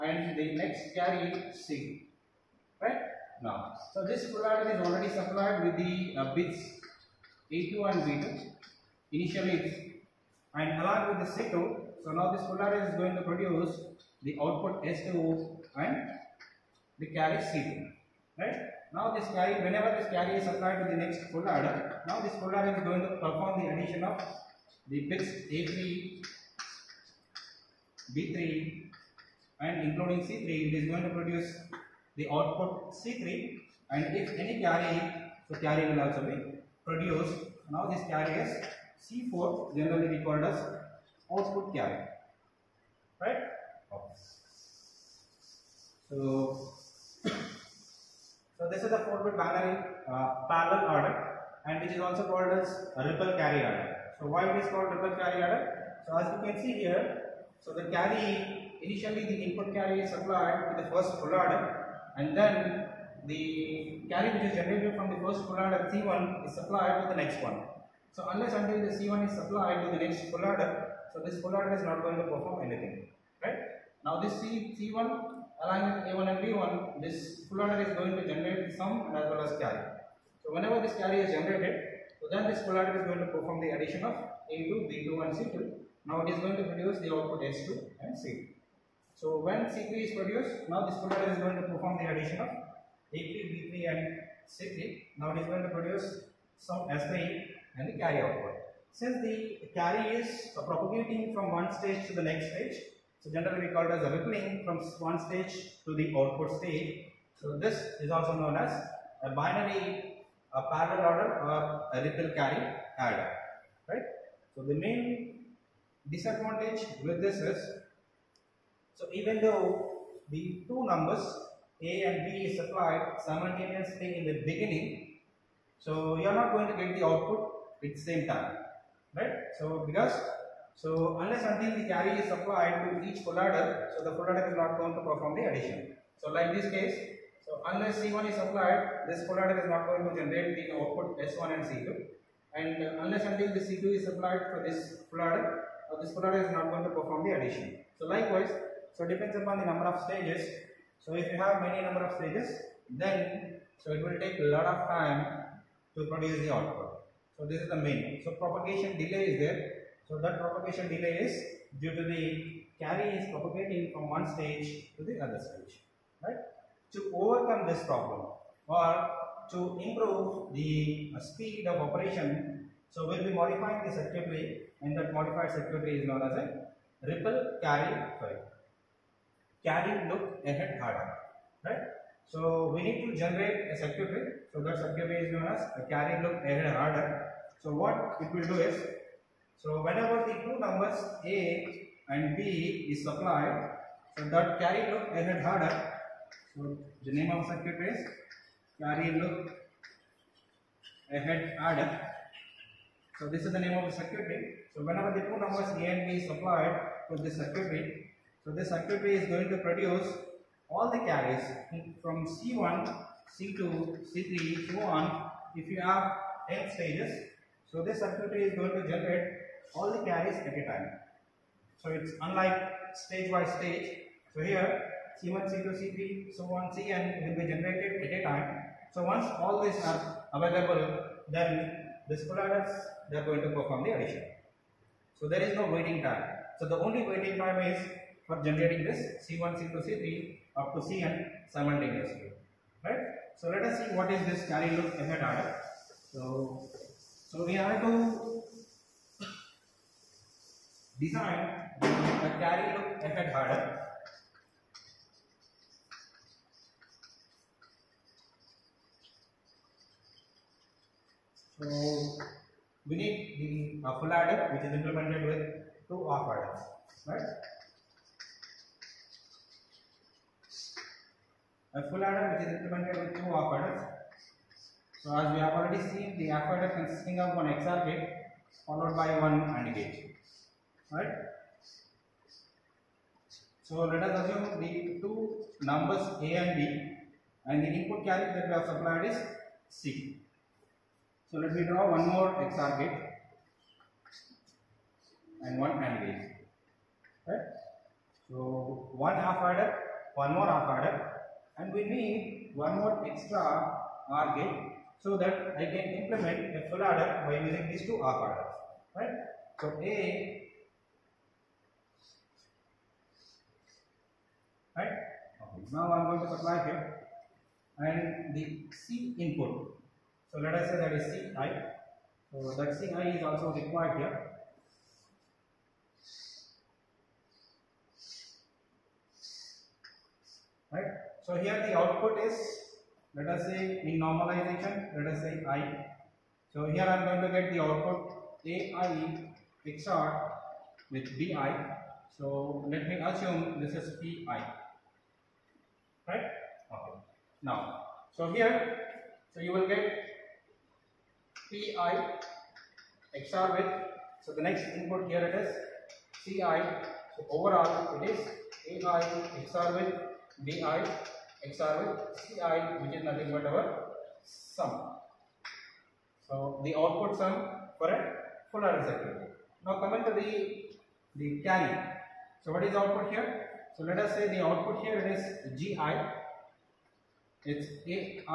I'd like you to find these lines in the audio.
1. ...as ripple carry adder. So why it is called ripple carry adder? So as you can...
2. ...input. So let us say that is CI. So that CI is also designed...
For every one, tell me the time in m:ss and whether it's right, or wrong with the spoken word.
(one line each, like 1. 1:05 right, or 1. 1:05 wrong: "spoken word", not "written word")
1. 0:52 right
2. 5:19 wrong: "required", not "designed".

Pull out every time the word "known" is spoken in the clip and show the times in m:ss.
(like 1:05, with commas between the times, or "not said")
1:48, 2:56, 3:05.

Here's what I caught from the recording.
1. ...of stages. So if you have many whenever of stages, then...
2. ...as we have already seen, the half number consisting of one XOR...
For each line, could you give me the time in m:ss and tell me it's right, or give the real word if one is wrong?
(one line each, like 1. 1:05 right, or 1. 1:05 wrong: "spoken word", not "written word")
1. 2:29 wrong: "number", not "whenever"
2. 4:35 wrong: "adder", not "number".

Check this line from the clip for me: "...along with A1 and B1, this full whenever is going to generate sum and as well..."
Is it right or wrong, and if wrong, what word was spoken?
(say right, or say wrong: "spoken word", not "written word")
wrong: "adder", not "whenever".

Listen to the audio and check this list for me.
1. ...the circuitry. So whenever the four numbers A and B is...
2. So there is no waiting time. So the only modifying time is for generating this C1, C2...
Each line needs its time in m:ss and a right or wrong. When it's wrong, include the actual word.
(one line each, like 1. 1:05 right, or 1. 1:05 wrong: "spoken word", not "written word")
1. 3:23 wrong: "two", not "four"
2. 3:55 wrong: "waiting", not "modifying".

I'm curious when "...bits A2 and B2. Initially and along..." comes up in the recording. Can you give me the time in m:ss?
0:06.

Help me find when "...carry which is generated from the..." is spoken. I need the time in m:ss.
1:04.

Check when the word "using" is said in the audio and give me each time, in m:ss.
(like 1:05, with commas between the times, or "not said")
5:07.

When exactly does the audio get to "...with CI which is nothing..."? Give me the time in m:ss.
6:01.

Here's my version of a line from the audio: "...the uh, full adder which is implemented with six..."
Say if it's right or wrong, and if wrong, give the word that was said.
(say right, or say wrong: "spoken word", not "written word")
wrong: "two", not "six".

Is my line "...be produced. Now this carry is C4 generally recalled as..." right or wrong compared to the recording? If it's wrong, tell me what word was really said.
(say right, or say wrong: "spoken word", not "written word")
right.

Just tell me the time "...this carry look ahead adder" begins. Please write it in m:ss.
4:04.